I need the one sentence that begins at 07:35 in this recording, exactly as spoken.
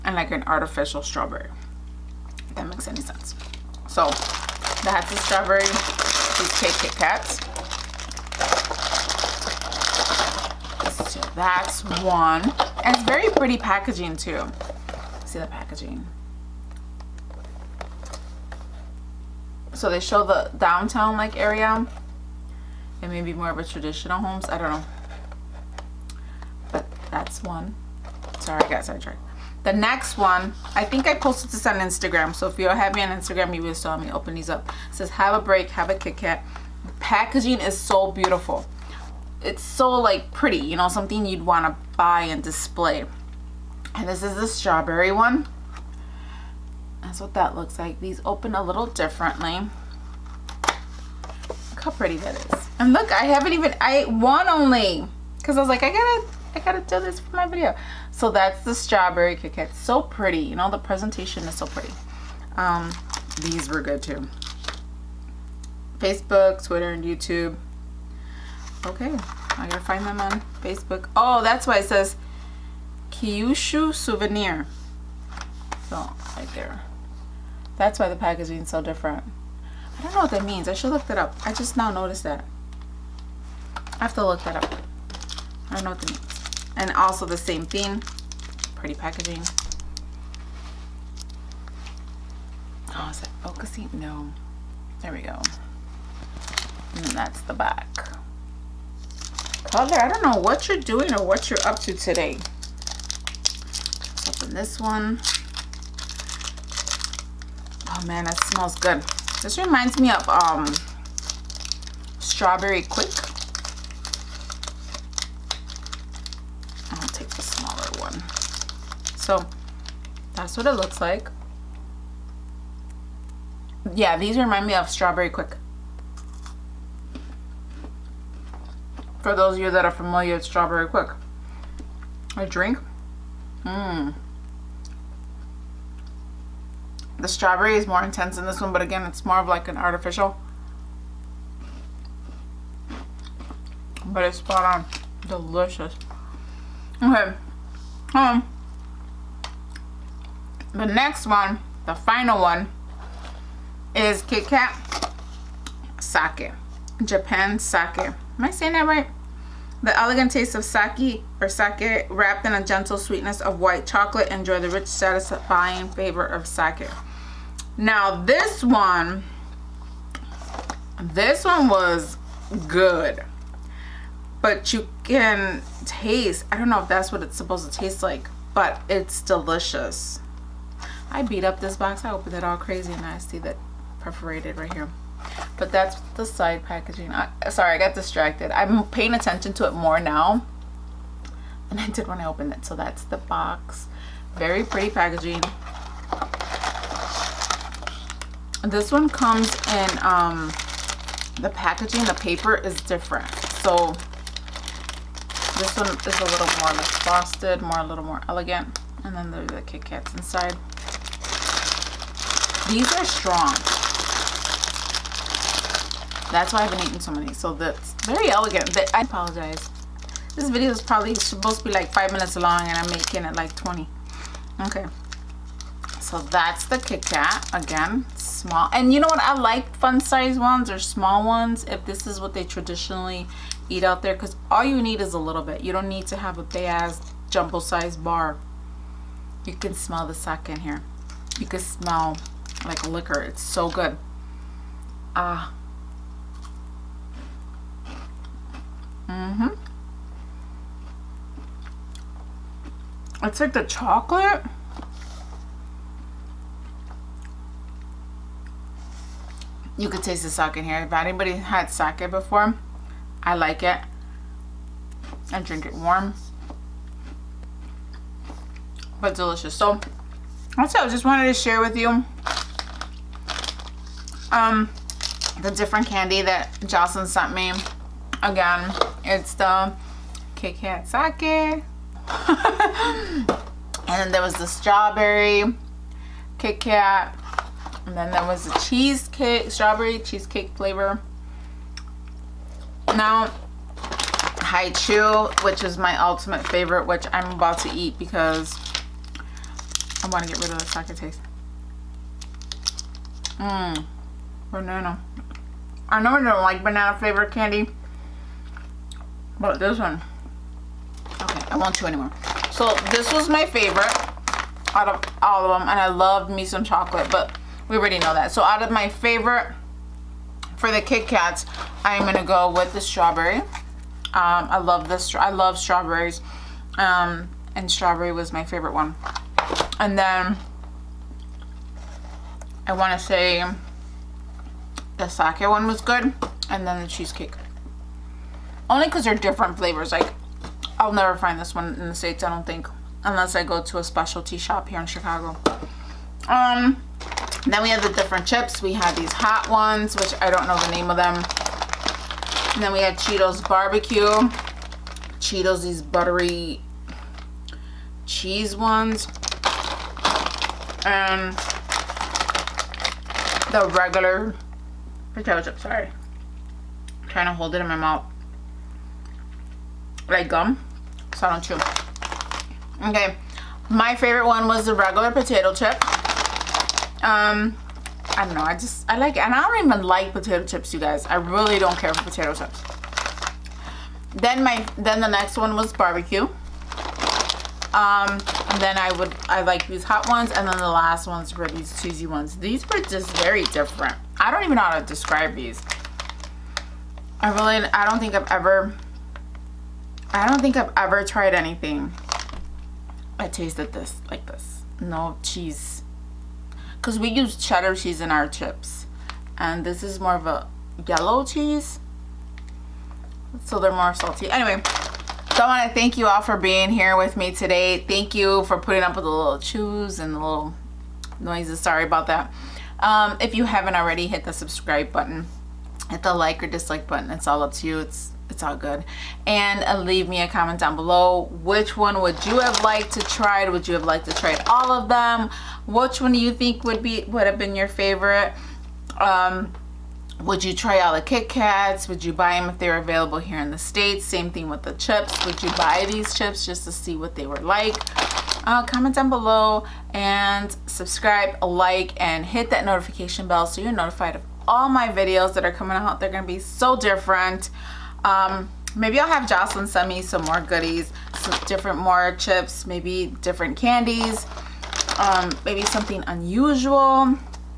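They're going to be so different.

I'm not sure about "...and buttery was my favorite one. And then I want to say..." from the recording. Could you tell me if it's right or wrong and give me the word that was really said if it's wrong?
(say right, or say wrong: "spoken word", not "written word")
wrong: "strawberry", not "buttery".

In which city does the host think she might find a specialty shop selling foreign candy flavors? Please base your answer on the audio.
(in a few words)
Chicago.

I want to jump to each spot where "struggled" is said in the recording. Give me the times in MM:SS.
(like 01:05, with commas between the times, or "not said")
not said.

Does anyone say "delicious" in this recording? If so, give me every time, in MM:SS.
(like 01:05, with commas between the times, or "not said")
02:25, 02:59, 04:29.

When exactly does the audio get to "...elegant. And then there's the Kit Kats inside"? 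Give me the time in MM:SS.
03:28.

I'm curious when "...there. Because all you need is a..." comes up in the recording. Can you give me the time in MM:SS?
03:54.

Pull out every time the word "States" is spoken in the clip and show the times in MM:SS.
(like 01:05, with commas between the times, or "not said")
05:41, 07:23.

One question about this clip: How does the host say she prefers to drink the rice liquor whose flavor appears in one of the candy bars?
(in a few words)
warm.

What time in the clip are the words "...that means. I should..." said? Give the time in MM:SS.
01:20.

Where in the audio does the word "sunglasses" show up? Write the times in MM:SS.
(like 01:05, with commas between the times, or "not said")
not said.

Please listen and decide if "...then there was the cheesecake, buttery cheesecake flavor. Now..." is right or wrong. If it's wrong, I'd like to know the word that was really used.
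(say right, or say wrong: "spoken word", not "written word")
wrong: "strawberry", not "buttery".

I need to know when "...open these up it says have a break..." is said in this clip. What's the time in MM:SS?
00:34.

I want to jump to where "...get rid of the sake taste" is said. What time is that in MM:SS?
05:00.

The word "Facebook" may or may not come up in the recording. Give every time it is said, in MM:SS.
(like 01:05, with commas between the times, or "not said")
01:05, 01:10.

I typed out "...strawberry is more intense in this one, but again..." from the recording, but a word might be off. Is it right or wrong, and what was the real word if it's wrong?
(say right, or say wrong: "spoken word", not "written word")
right.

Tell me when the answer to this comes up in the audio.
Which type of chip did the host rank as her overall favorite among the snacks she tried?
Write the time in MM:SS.
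06:14.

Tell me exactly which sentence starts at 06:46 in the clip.
Because we use cheddar cheese in our chips.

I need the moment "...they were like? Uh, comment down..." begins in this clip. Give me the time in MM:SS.
07:27.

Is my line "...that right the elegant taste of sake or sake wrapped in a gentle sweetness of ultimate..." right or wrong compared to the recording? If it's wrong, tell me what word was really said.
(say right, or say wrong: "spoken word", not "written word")
wrong: "white", not "ultimate".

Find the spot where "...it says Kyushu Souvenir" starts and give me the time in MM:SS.
01:11.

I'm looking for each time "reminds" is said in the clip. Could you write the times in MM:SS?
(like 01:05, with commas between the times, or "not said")
01:49, 02:04.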